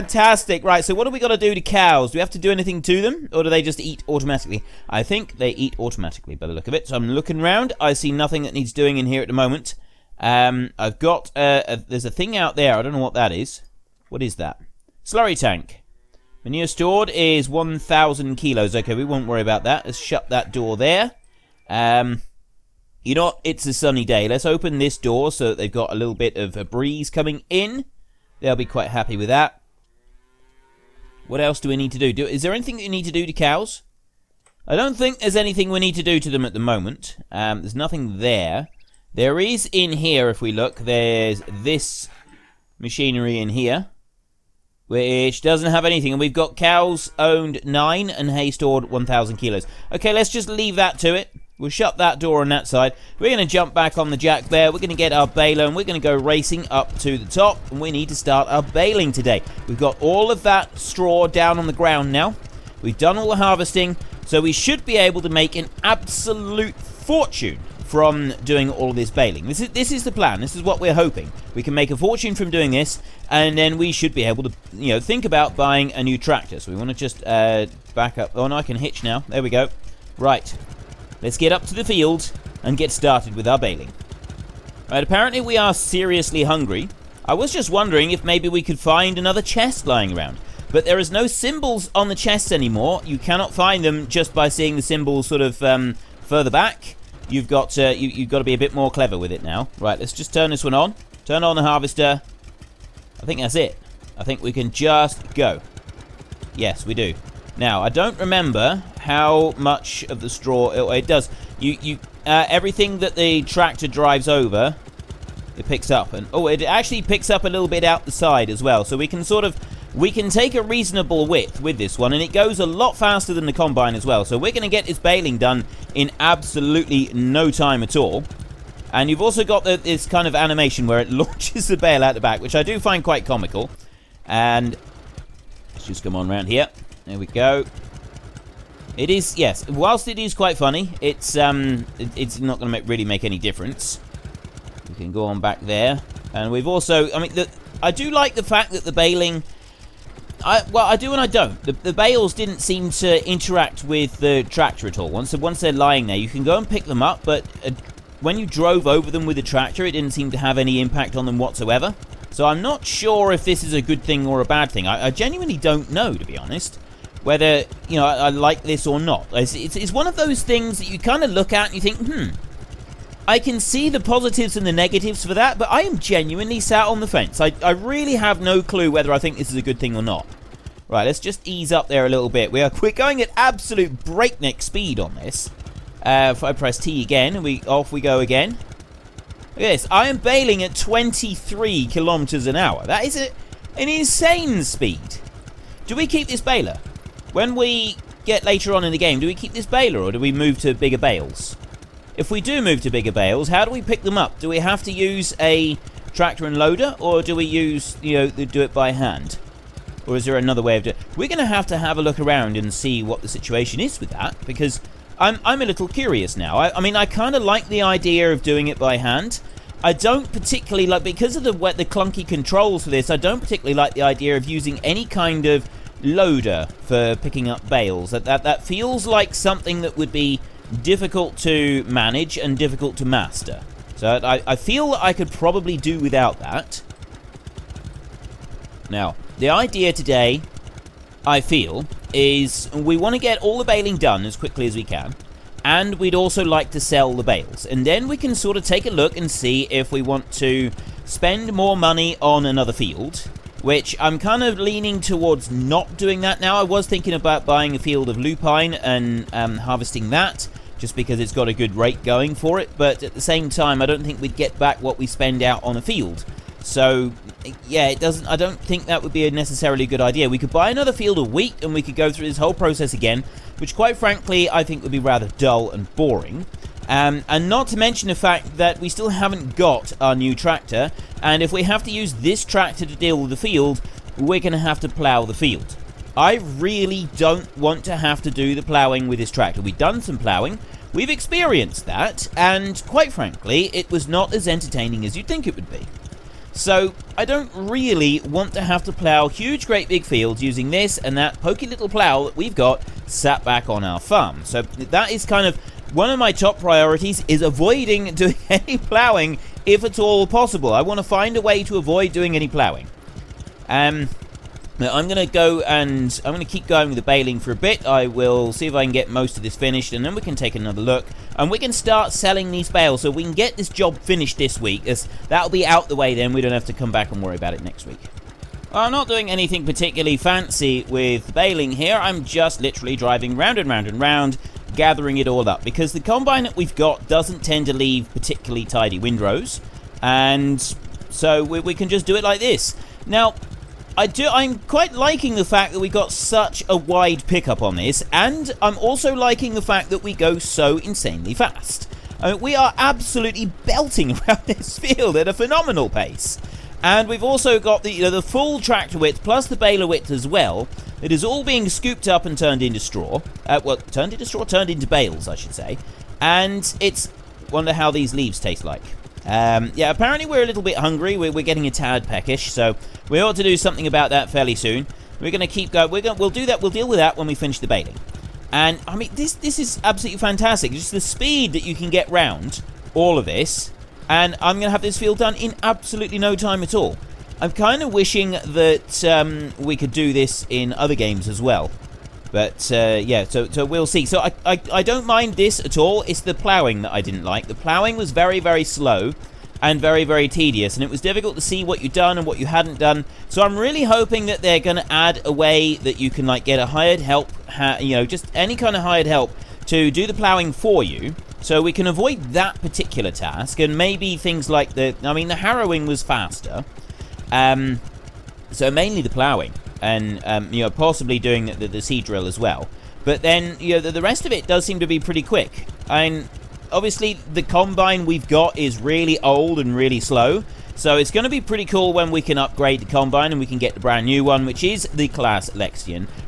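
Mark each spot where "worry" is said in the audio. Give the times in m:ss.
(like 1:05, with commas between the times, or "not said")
0:19, 5:27.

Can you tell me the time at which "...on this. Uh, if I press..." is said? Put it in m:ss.
3:04.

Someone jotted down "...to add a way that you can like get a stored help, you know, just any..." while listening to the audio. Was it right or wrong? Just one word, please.
wrong.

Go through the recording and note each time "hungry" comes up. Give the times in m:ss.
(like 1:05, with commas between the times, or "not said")
1:26, 6:10.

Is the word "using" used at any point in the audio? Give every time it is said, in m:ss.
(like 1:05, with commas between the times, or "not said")
3:44, 5:00.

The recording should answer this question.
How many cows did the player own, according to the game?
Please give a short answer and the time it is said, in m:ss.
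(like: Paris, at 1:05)
9, at 0:46.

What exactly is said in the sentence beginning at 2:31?
The, the bales didn't seem to interact with the tractor at all.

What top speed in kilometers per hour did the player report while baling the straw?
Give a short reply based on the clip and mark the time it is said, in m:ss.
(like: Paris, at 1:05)
23, at 3:10.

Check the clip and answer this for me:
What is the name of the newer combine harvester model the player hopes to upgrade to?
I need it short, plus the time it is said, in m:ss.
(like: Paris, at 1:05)
Claas Lexion, at 7:15.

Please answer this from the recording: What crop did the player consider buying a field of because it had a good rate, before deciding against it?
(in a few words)
Lupine.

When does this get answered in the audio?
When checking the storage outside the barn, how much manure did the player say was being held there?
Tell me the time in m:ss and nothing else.
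0:16.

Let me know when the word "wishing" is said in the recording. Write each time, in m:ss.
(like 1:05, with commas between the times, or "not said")
6:27.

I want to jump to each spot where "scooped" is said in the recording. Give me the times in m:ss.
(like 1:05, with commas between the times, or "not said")
6:01.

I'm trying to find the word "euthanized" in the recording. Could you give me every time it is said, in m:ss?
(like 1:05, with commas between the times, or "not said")
not said.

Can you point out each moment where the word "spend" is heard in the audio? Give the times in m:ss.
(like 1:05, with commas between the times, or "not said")
4:11, 4:25.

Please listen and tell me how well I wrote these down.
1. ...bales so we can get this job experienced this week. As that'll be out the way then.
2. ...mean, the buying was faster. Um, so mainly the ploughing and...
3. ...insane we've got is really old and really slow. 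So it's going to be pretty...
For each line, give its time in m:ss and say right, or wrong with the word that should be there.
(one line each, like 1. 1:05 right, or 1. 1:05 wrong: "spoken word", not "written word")
1. 5:22 wrong: "finished", not "experienced"
2. 6:55 wrong: "harrowing", not "buying"
3. 7:07 wrong: "combine", not "insane".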